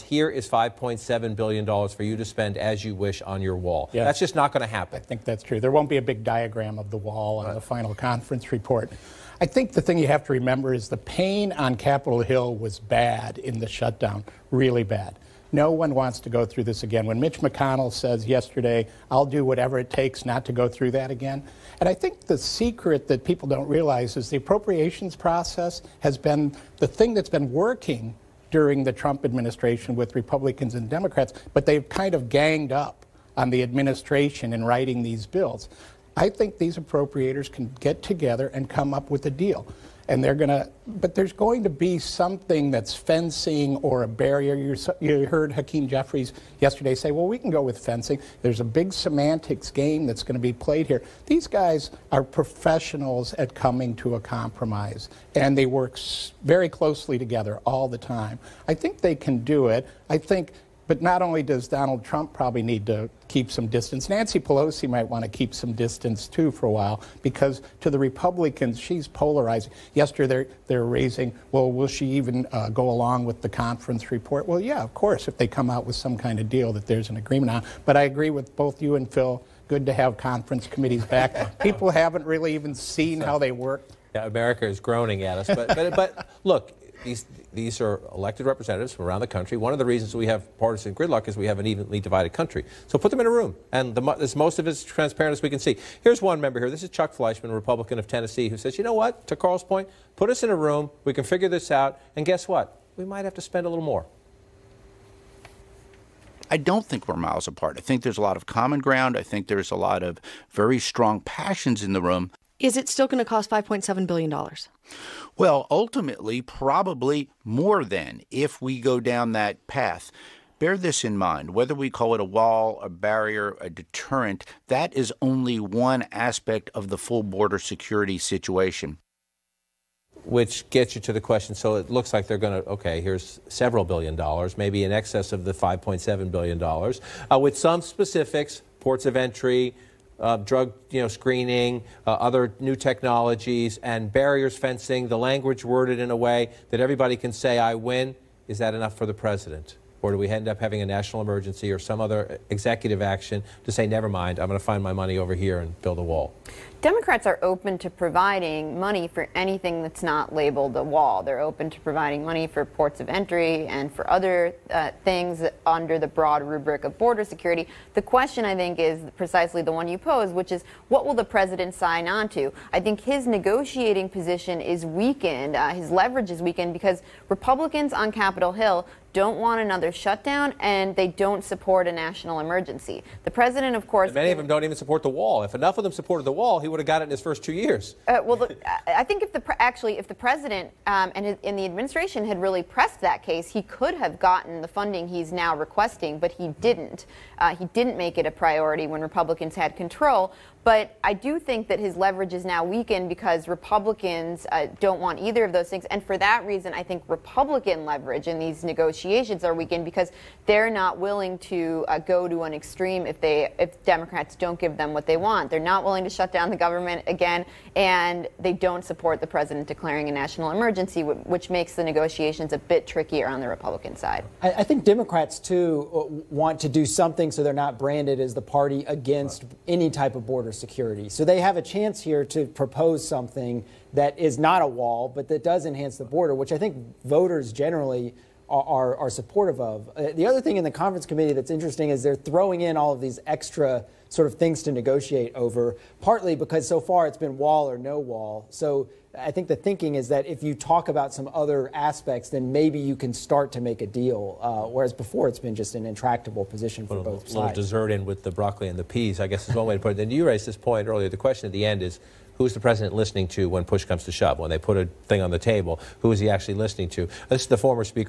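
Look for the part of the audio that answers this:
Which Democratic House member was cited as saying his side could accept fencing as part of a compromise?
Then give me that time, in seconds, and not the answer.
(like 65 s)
45 s.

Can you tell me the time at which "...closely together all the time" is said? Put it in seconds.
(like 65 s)
56 s.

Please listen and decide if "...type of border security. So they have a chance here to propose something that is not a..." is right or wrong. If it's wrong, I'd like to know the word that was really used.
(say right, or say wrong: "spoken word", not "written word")
right.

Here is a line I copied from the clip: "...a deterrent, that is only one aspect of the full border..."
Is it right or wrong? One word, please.
right.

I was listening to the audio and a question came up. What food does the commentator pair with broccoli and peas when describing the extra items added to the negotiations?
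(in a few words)
dessert.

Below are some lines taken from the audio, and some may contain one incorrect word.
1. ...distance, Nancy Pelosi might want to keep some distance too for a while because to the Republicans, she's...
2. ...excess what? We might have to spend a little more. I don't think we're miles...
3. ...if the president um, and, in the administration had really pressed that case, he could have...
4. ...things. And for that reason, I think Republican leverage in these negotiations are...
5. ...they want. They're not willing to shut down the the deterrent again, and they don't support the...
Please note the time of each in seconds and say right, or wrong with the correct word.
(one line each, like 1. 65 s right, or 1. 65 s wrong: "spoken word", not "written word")
1. 63 s right
2. 102 s wrong: "guess", not "excess"
3. 189 s right
4. 205 s right
5. 215 s wrong: "government", not "deterrent".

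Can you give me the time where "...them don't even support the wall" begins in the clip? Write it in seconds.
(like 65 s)
184 s.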